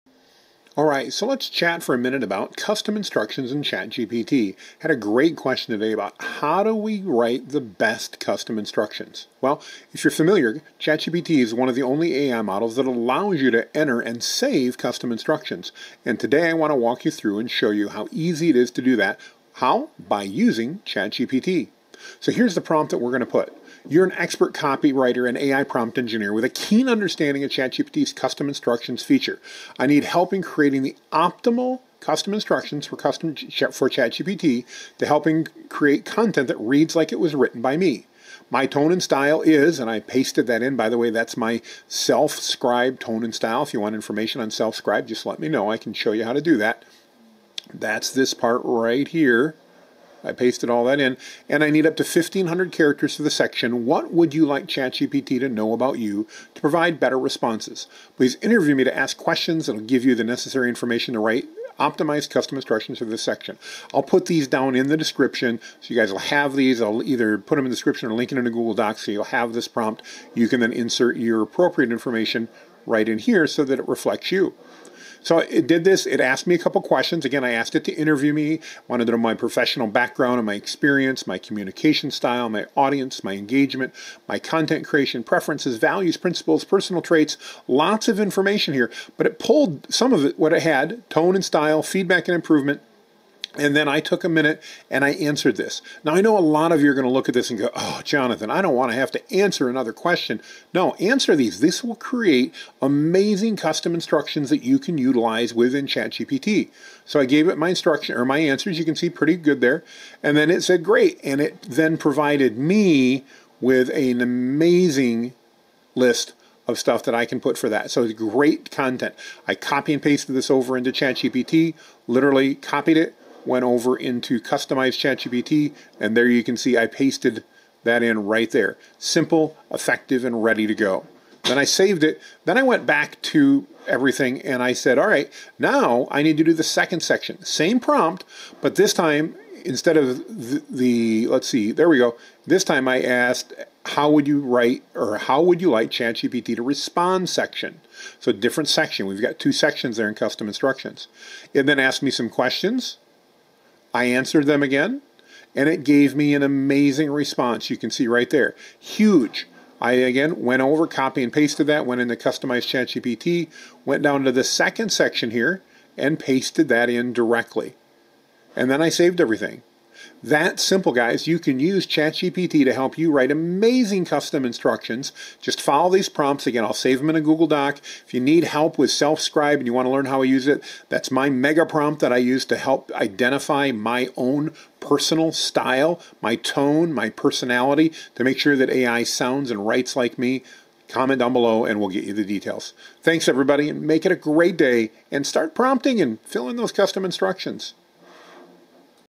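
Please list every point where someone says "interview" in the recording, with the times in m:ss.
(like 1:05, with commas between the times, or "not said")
0:58, 1:17.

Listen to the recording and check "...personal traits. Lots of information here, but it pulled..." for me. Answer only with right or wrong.
right.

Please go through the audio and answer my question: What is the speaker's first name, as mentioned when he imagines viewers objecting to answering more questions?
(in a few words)
Jonathan.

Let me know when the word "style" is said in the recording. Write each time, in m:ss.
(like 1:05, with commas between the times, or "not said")
0:39, 0:43, 1:22, 1:31, 3:05.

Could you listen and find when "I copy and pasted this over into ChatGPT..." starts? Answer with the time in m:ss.
1:59.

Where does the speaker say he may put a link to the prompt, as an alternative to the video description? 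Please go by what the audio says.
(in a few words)
Google Docs.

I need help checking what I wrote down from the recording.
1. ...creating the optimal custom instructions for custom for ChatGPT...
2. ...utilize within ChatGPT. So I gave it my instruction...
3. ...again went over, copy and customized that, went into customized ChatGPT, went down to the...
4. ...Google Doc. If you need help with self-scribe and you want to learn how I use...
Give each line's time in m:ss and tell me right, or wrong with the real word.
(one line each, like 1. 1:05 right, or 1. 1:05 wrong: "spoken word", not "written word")
1. 0:30 right
2. 1:44 right
3. 2:39 wrong: "pasted", not "customized"
4. 2:57 right.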